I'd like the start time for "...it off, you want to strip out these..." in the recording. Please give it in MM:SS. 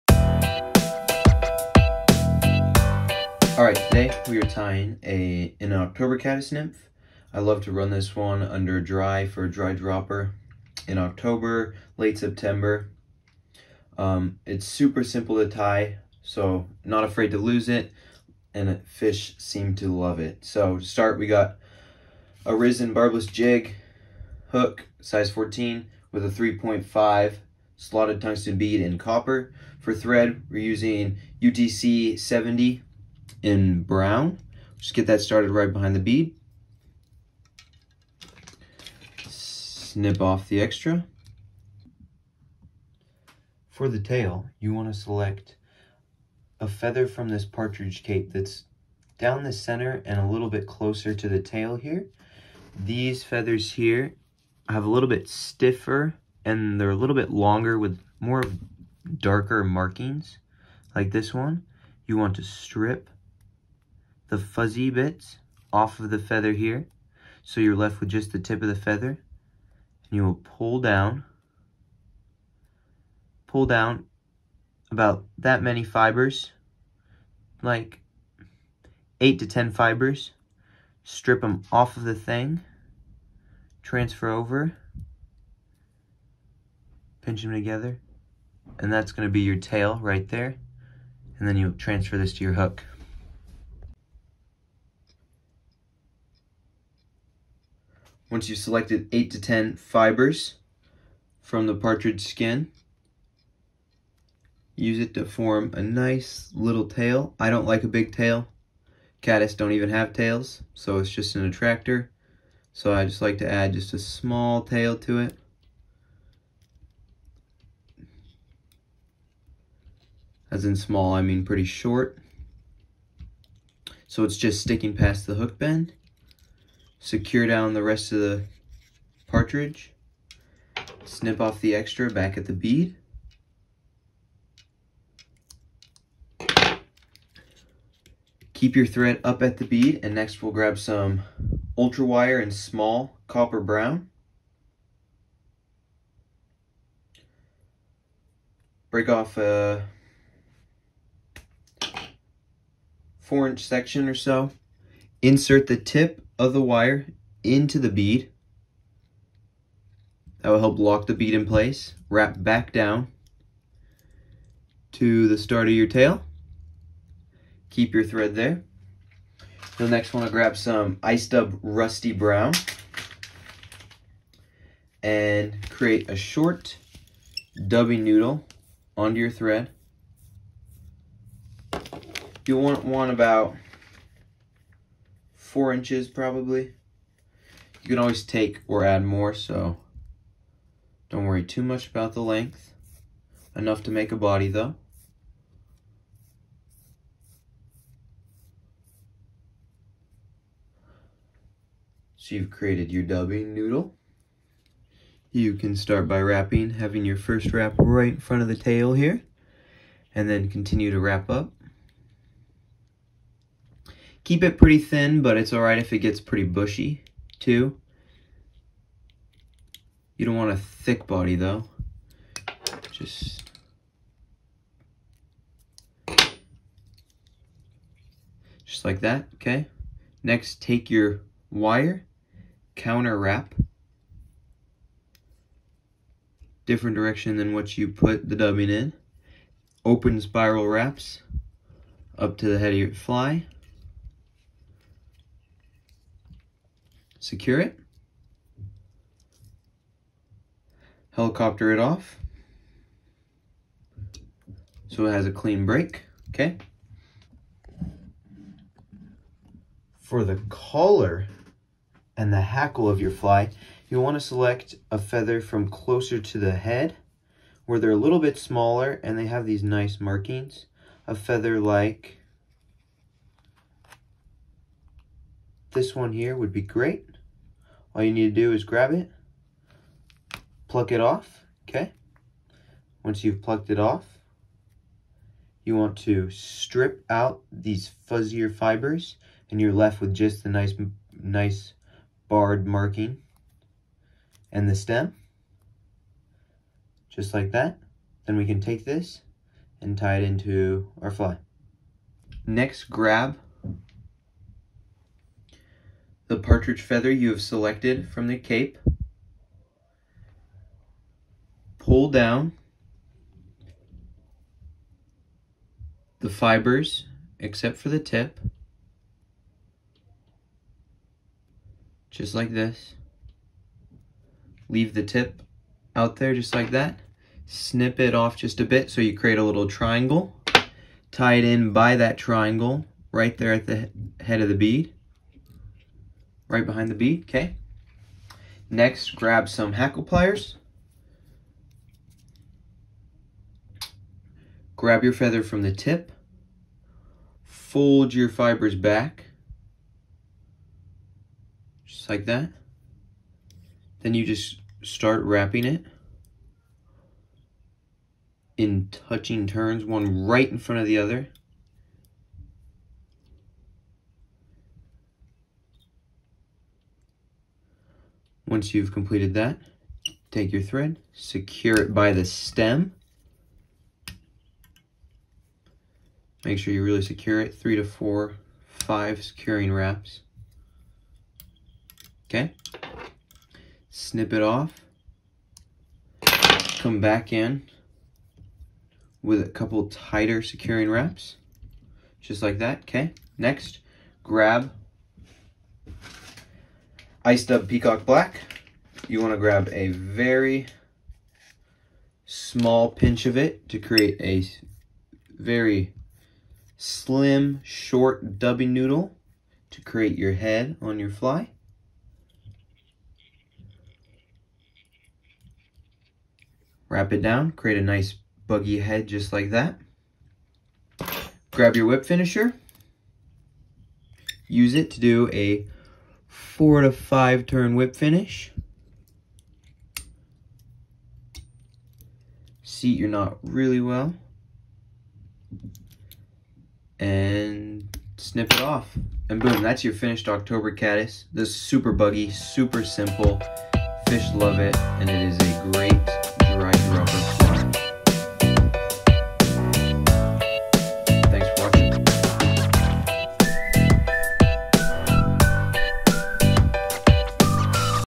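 04:43.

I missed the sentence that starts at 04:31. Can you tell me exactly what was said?
A feather like this one here would be great.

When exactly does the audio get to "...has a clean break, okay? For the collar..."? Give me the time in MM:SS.
04:15.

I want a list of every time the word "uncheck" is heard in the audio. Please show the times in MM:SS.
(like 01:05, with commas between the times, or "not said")
not said.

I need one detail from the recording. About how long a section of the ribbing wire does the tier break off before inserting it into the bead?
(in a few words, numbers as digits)
4 inches.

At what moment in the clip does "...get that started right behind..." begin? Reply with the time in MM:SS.
00:34.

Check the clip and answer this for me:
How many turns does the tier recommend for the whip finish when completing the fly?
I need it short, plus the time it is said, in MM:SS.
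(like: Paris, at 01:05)
4 to 5, at 07:06.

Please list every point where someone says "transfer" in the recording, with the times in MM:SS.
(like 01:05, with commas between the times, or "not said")
01:23, 01:31.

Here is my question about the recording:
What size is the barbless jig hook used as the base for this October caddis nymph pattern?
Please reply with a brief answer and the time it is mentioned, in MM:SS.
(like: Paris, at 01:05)
14, at 00:25.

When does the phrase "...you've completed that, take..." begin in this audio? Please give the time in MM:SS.
06:08.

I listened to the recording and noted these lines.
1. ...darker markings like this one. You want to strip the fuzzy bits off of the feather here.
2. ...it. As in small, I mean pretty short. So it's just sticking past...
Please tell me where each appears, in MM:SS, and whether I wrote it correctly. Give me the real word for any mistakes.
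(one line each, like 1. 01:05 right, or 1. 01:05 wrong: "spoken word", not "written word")
1. 00:59 right
2. 01:55 right.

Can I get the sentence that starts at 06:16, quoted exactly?
Make sure you really secure it, three to four, five securing wraps.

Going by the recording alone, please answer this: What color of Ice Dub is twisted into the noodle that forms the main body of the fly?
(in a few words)
Rusty Brown.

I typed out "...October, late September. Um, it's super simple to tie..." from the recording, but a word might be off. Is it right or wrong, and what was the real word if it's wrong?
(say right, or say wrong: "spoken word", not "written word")
right.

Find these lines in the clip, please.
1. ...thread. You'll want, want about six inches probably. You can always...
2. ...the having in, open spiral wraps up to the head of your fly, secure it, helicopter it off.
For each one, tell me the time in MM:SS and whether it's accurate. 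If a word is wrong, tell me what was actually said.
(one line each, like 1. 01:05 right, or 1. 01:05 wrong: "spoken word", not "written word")
1. 02:59 wrong: "four", not "six"
2. 03:58 wrong: "dubbing", not "having".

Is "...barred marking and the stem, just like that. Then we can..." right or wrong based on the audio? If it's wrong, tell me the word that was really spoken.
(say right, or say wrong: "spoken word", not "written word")
right.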